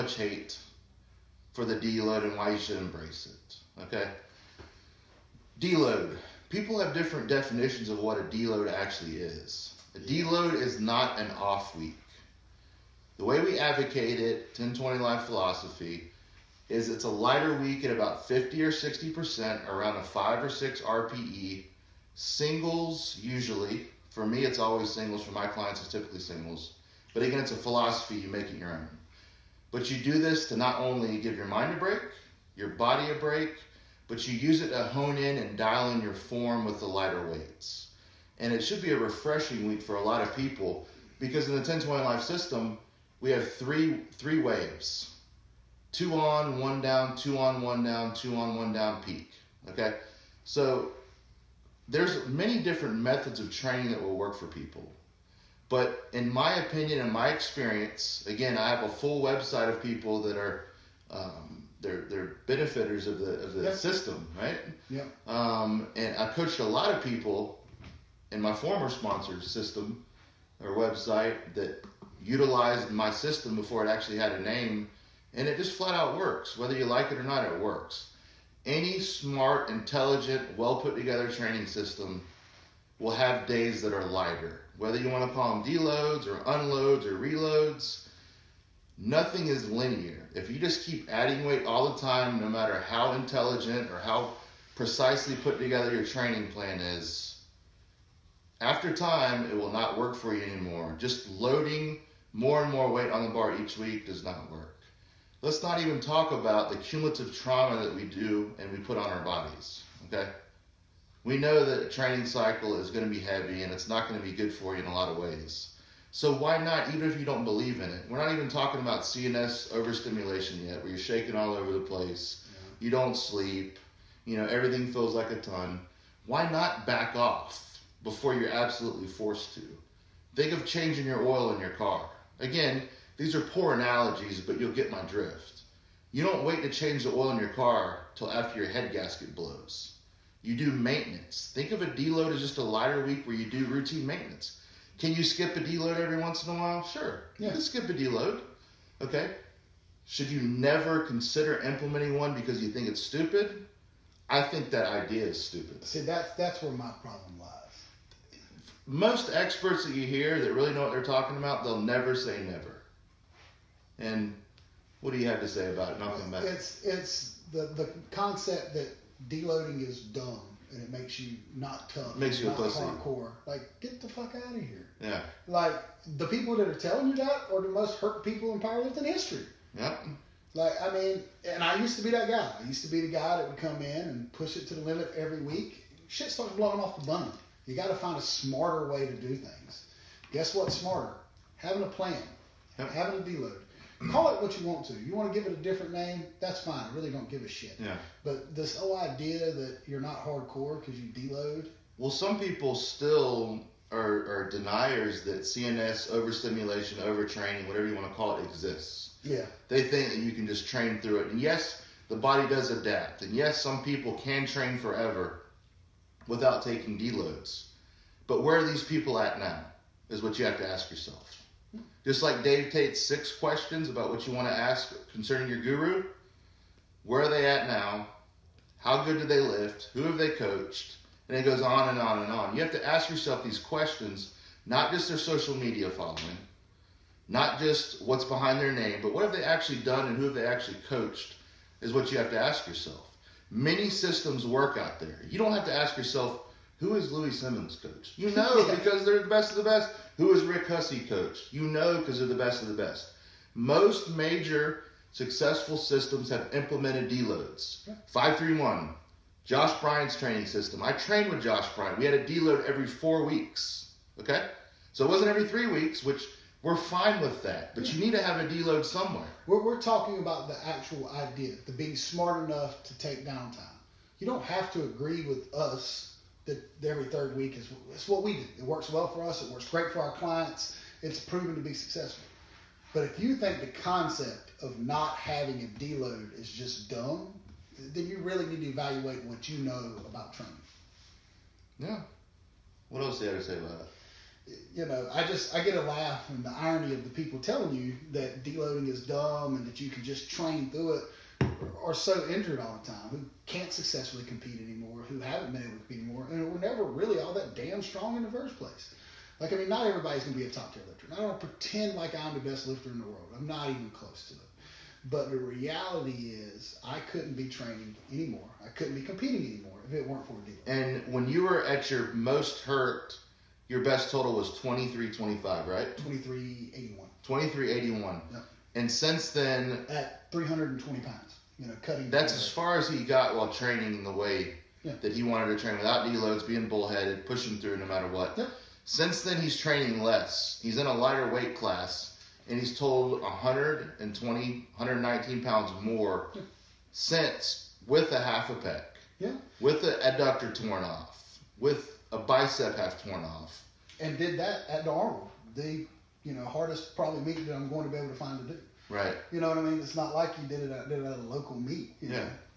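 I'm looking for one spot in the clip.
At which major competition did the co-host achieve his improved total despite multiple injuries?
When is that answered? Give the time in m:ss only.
5:54.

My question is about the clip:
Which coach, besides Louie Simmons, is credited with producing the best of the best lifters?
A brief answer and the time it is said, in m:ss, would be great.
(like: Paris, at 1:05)
Rick Hussey, at 4:10.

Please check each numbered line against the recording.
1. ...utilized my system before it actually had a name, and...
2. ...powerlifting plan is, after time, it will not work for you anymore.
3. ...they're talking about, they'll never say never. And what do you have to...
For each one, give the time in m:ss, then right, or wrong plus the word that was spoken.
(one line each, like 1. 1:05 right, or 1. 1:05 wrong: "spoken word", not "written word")
1. 1:12 right
2. 1:36 wrong: "training", not "powerlifting"
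3. 2:40 right.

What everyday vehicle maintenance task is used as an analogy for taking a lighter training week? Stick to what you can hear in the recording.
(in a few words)
Changing your oil.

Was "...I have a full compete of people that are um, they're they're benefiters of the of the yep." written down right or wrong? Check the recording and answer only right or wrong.
wrong.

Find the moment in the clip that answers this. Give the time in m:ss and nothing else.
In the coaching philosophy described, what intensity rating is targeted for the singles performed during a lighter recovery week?
0:20.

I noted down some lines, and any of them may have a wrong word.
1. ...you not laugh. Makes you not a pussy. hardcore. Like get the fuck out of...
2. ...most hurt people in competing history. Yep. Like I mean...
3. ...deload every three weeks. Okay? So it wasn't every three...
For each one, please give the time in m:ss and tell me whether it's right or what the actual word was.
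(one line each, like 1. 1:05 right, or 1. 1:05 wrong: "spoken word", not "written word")
1. 2:51 wrong: "tough", not "laugh"
2. 2:57 wrong: "powerlifting", not "competing"
3. 4:22 wrong: "four", not "three".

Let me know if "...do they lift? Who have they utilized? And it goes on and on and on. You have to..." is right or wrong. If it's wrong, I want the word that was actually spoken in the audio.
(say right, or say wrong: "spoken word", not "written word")
wrong: "coached", not "utilized".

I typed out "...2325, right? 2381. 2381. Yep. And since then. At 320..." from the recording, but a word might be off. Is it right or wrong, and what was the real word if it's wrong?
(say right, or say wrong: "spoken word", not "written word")
right.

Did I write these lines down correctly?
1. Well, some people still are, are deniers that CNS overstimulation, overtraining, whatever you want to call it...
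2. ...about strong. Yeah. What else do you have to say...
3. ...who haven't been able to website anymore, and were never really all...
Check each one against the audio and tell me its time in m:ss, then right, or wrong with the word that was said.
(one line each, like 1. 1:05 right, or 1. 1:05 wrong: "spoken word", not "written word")
1. 3:21 right
2. 4:50 wrong: "training", not "strong"
3. 5:05 wrong: "compete", not "website".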